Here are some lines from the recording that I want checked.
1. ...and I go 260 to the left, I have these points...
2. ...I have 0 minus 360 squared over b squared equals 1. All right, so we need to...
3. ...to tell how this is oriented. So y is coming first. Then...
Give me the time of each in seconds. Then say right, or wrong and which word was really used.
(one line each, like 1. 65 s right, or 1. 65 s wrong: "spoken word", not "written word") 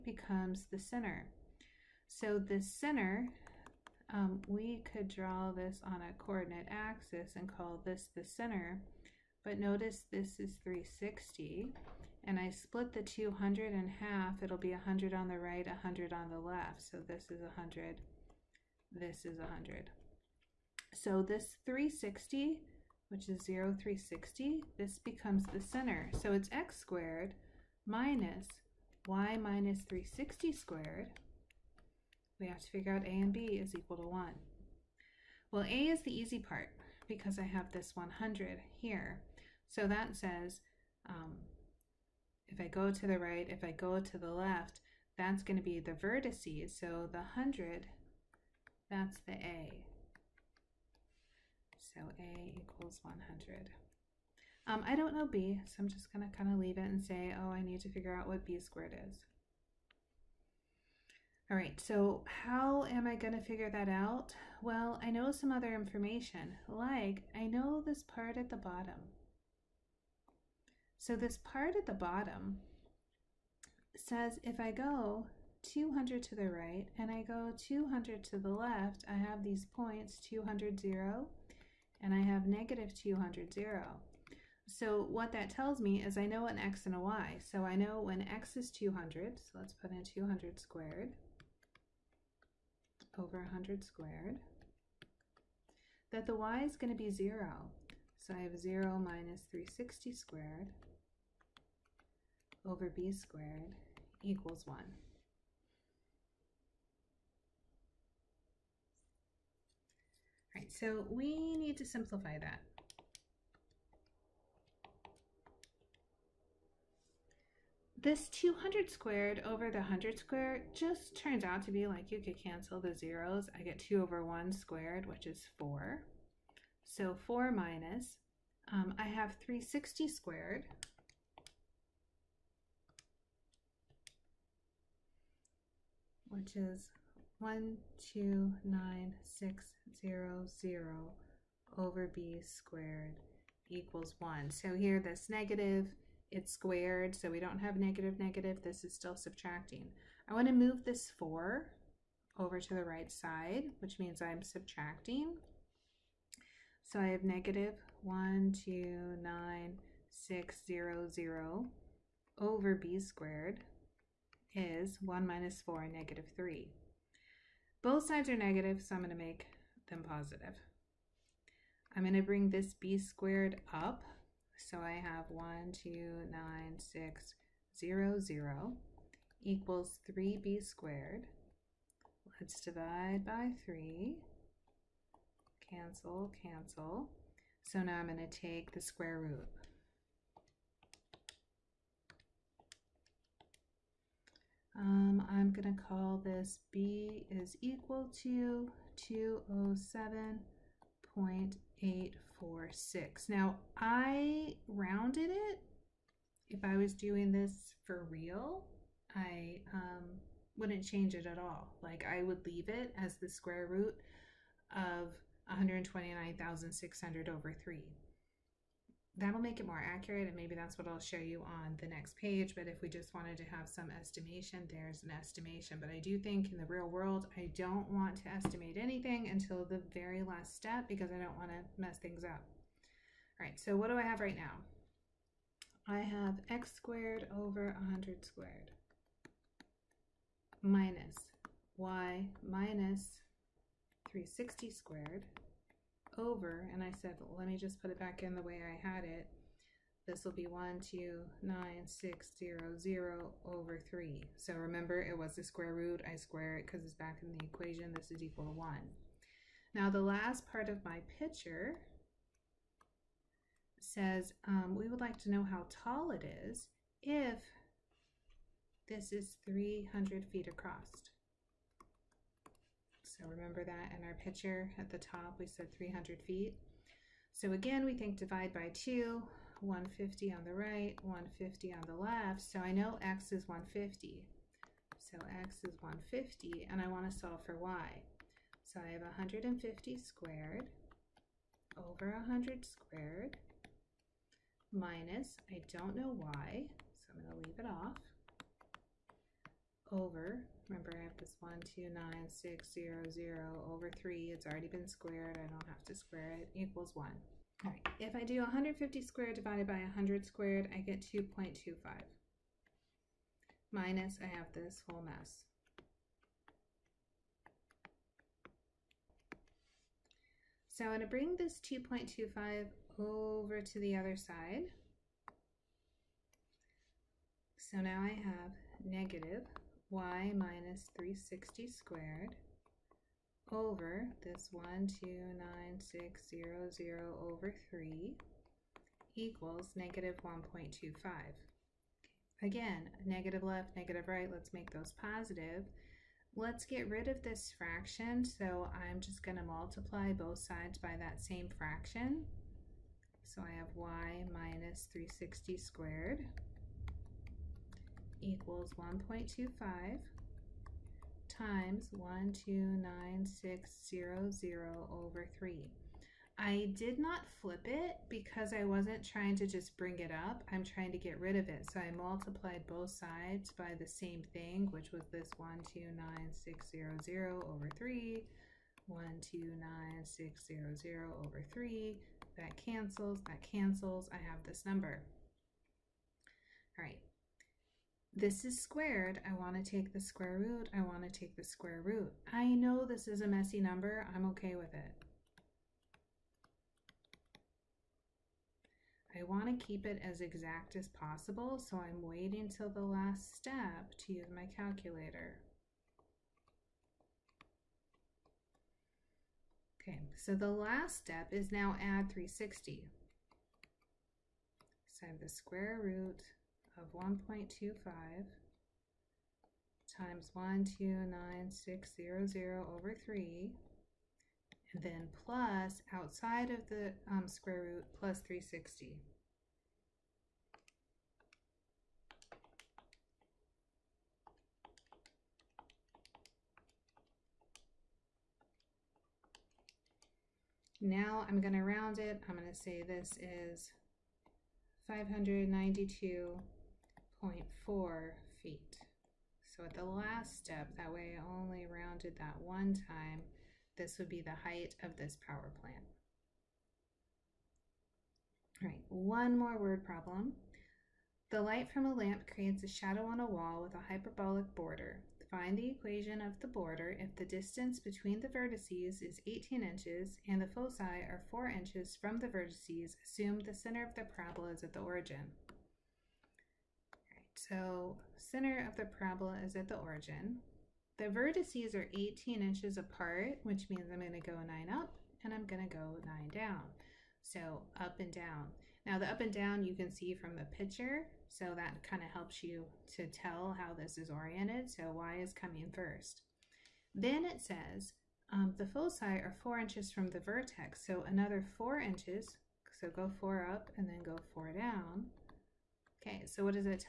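1. 76 s wrong: "200", not "260"
2. 98 s right
3. 492 s right.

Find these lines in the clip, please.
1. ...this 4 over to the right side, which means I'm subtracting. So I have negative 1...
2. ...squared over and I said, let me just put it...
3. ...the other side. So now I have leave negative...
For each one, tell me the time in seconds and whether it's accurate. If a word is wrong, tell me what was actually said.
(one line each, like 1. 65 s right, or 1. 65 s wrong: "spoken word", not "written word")
1. 150 s right
2. 244 s right
3. 323 s wrong: "negative", not "leave".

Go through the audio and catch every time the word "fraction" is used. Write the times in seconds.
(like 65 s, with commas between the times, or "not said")
347 s, 351 s.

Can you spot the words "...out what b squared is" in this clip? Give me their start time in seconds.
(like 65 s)
58 s.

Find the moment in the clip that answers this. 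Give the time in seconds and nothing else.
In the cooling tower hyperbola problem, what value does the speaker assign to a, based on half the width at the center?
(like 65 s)
52 s.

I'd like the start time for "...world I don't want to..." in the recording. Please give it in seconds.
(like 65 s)
226 s.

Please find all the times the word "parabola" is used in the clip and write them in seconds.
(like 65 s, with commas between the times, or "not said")
474 s, 478 s.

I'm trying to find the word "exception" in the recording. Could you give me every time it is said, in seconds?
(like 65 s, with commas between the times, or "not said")
not said.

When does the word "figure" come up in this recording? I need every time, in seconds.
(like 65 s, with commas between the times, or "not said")
32 s, 57 s, 63 s.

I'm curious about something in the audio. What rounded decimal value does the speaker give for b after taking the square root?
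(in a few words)
207.8846.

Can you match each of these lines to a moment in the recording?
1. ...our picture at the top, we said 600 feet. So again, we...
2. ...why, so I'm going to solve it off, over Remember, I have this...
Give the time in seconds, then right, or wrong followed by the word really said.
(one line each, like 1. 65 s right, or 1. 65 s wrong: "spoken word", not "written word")
1. 274 s wrong: "300", not "600"
2. 296 s wrong: "leave", not "solve".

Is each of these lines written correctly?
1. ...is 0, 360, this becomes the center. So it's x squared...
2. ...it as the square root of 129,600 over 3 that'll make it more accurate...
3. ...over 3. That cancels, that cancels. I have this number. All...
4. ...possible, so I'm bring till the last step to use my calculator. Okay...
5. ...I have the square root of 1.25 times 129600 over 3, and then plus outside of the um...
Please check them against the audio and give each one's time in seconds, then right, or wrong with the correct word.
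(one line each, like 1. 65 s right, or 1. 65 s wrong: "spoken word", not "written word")
1. 23 s right
2. 212 s right
3. 381 s right
4. 400 s wrong: "waiting", not "bring"
5. 415 s right.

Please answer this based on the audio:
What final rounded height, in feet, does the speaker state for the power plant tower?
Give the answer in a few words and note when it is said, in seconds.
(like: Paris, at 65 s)
592.4 feet, at 444 s.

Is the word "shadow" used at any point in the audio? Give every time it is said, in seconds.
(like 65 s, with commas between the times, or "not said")
462 s.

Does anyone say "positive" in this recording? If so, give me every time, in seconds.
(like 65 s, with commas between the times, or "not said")
170 s, 345 s.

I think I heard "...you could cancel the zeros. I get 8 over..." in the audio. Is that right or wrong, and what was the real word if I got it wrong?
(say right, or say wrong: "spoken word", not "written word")
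wrong: "2", not "8".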